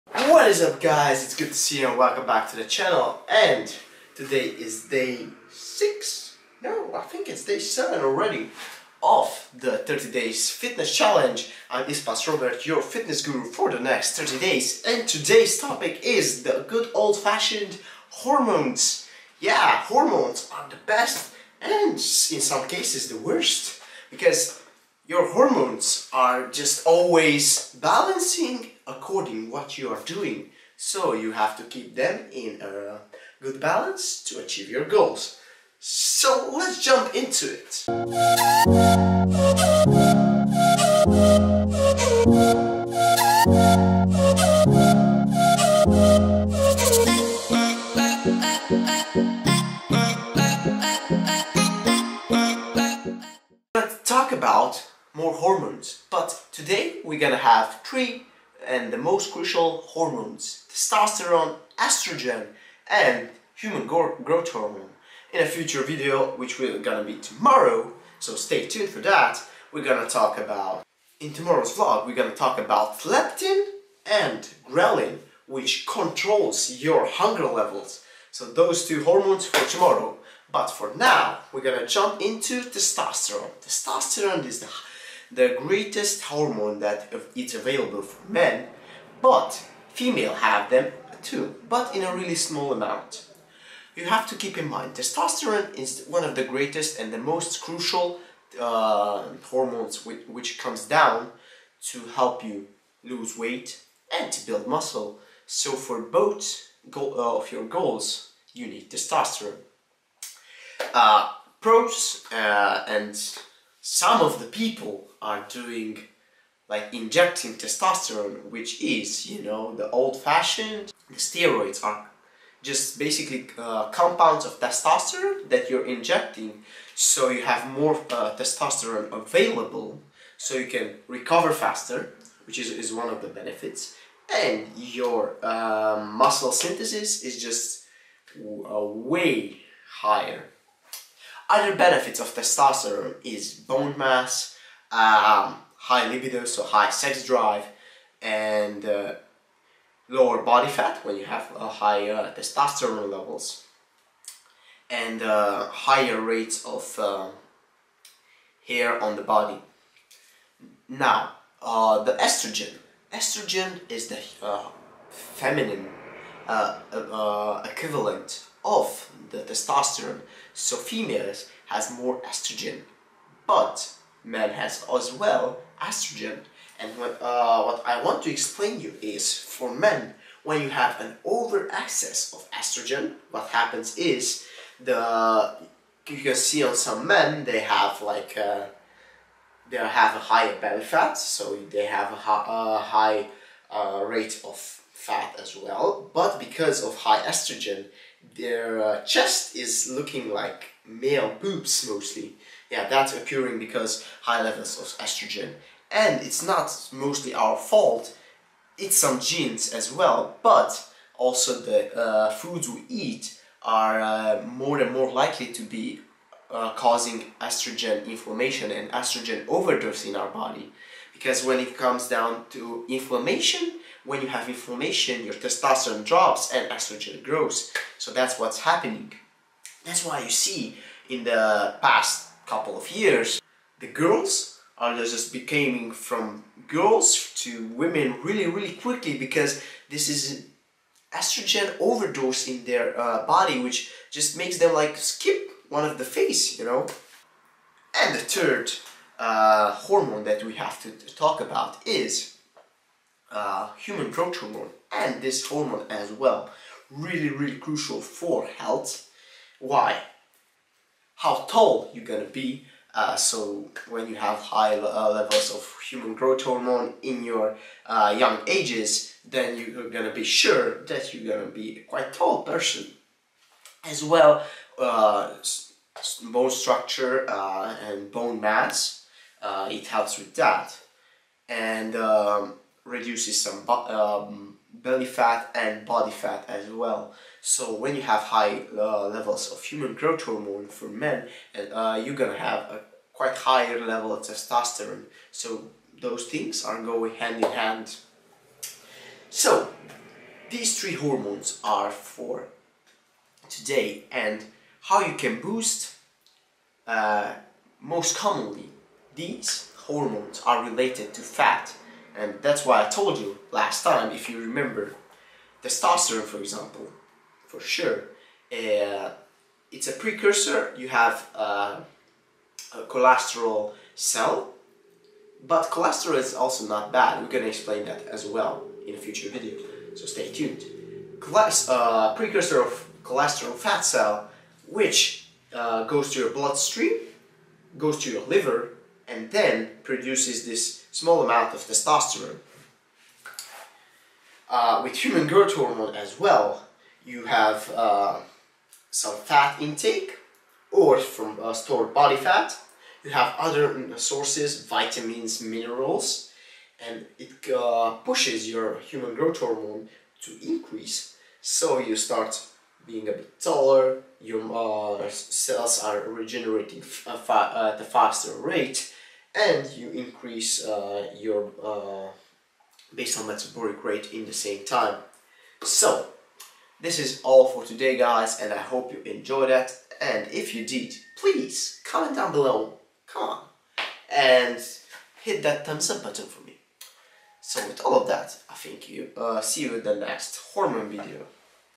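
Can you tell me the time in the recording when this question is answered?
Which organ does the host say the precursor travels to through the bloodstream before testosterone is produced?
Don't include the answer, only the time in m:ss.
5:38.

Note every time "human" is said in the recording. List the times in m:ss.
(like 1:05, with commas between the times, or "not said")
1:03, 4:13, 4:25, 4:49, 5:44, 5:58.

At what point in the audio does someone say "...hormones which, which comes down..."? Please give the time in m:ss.
1:39.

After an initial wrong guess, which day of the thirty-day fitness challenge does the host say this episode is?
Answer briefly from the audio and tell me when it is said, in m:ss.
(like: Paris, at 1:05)
Day 7, at 0:07.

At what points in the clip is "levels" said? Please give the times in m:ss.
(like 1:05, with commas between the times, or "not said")
1:17, 2:33, 3:24, 4:25, 4:49, 4:53.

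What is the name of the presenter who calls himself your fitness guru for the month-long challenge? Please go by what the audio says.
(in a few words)
Ispas Robert.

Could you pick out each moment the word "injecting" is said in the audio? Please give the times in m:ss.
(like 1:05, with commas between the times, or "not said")
1:56, 2:05.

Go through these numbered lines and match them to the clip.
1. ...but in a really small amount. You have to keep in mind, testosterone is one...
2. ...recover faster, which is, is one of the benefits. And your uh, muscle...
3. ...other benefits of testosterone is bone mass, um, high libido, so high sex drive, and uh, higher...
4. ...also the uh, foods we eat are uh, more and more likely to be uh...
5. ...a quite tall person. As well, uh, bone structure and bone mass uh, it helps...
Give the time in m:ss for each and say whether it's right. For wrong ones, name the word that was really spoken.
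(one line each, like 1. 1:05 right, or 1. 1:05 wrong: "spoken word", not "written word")
1. 1:31 right
2. 2:11 right
3. 2:21 wrong: "lower", not "higher"
4. 3:31 right
5. 4:31 right.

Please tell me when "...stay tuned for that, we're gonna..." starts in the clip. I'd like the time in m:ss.
1:08.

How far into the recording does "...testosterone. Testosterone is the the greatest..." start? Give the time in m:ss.
1:22.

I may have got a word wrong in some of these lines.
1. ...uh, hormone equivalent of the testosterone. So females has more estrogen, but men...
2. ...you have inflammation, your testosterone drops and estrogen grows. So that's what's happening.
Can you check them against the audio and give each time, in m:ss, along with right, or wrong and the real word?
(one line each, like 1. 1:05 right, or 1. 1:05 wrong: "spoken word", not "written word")
1. 2:44 wrong: "feminine", not "hormone"
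2. 3:44 right.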